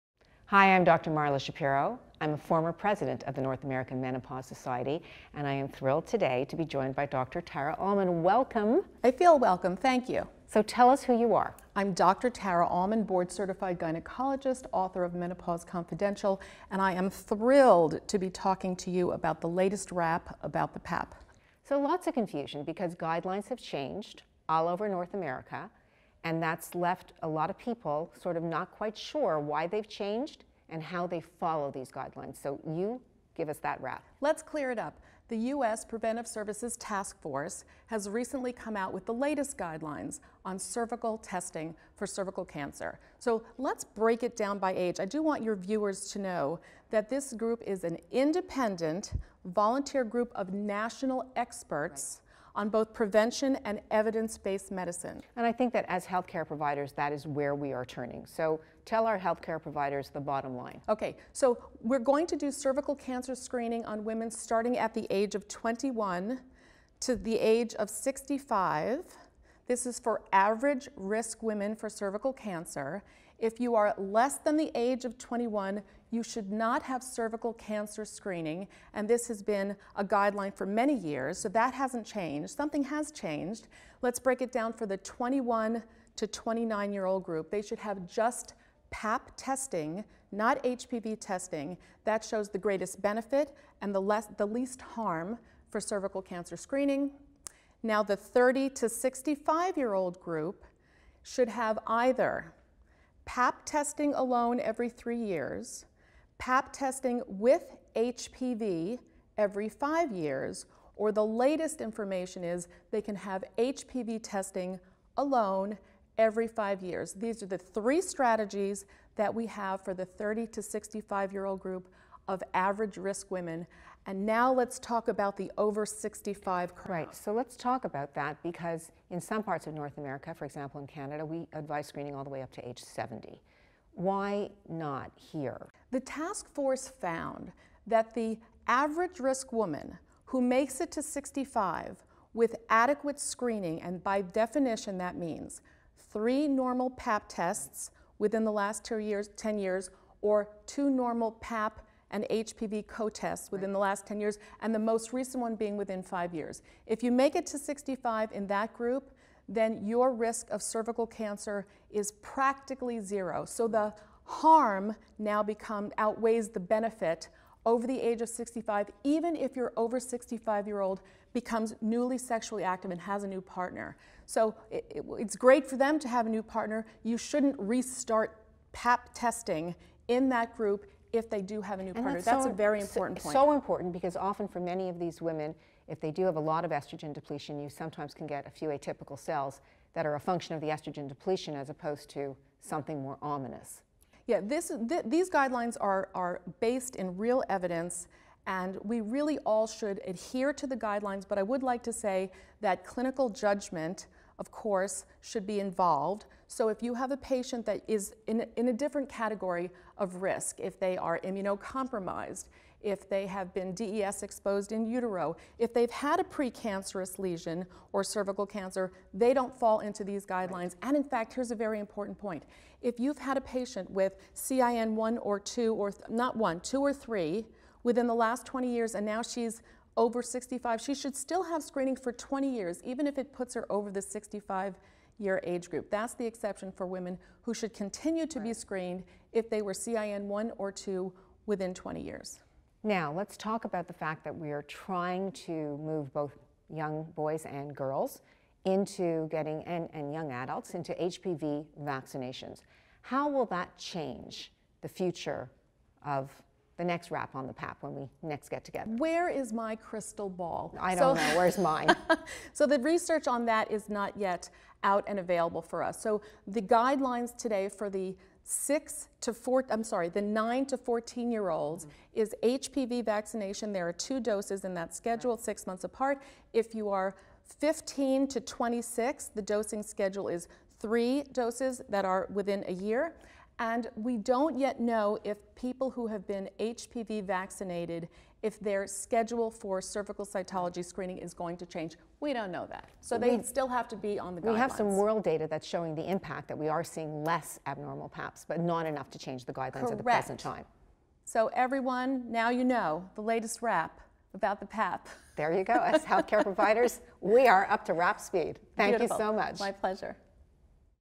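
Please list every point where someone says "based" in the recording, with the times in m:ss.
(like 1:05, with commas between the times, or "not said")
0:53, 3:16.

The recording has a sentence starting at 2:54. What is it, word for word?
So it, it, it's great for them to have a new partner.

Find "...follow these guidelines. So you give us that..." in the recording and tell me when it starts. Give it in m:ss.
0:31.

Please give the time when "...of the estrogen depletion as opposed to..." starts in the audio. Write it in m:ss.
3:10.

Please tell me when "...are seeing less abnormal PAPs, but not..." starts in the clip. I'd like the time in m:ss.
4:56.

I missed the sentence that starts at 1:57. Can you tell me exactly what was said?
These are the three strategies that we have for the 30 to 65 year old group of average risk women.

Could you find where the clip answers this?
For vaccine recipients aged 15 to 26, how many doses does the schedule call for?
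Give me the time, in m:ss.
4:40.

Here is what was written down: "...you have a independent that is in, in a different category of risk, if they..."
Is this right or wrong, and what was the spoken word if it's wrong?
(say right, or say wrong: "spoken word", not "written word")
wrong: "patient", not "independent".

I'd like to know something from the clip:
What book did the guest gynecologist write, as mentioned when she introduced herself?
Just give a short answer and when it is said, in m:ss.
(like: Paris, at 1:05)
Menopause Confidential, at 0:15.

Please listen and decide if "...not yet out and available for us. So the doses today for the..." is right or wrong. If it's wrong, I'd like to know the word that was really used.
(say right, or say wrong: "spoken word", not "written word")
wrong: "guidelines", not "doses".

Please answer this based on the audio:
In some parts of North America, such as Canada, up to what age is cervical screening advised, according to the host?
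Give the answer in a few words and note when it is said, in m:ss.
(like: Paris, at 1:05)
70, at 2:12.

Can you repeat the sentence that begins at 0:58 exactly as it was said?
So tell our healthcare providers the bottom line.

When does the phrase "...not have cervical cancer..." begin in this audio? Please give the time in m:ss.
1:16.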